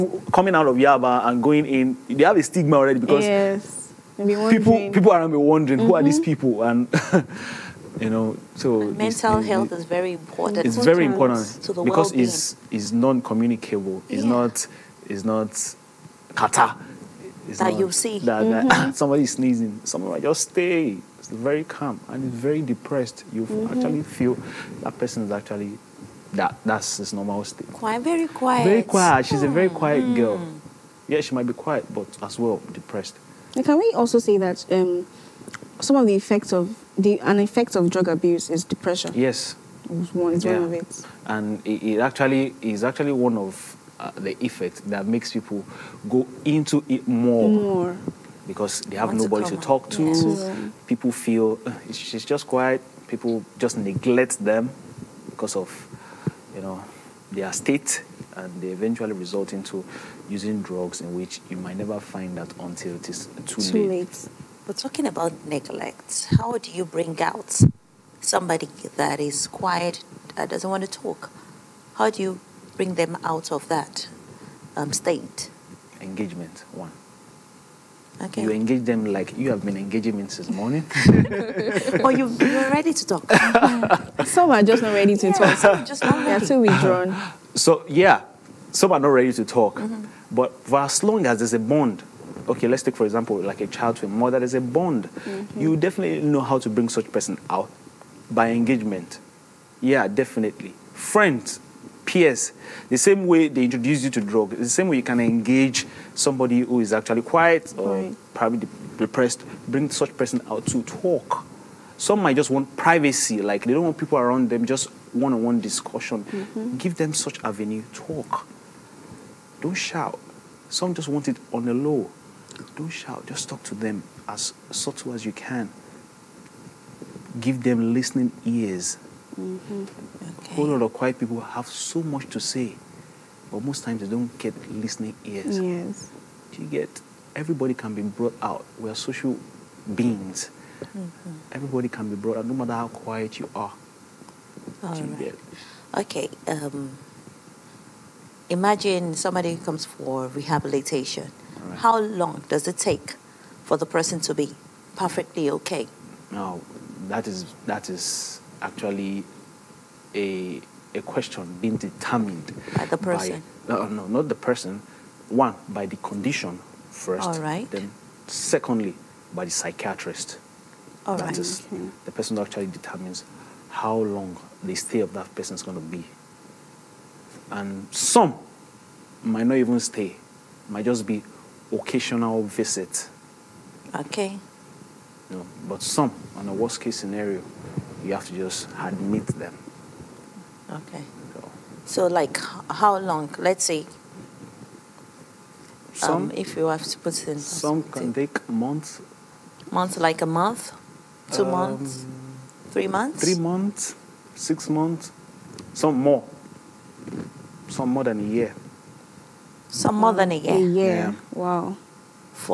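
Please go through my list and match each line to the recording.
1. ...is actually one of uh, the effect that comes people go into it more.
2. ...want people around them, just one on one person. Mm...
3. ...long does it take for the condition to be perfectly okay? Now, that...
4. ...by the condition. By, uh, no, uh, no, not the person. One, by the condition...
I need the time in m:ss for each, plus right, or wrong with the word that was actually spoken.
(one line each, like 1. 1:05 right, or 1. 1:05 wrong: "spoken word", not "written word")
1. 0:42 wrong: "makes", not "comes"
2. 1:53 wrong: "discussion", not "person"
3. 2:32 wrong: "person", not "condition"
4. 2:42 wrong: "person", not "condition".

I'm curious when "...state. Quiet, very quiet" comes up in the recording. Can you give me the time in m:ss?
0:27.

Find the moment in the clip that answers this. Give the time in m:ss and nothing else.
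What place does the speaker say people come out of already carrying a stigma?
0:00.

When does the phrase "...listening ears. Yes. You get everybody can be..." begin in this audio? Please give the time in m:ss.
2:14.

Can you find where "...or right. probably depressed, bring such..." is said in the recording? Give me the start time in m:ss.
1:47.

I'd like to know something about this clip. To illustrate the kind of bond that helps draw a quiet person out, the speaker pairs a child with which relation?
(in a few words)
mother.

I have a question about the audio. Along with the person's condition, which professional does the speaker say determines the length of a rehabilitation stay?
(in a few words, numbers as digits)
psychiatrist.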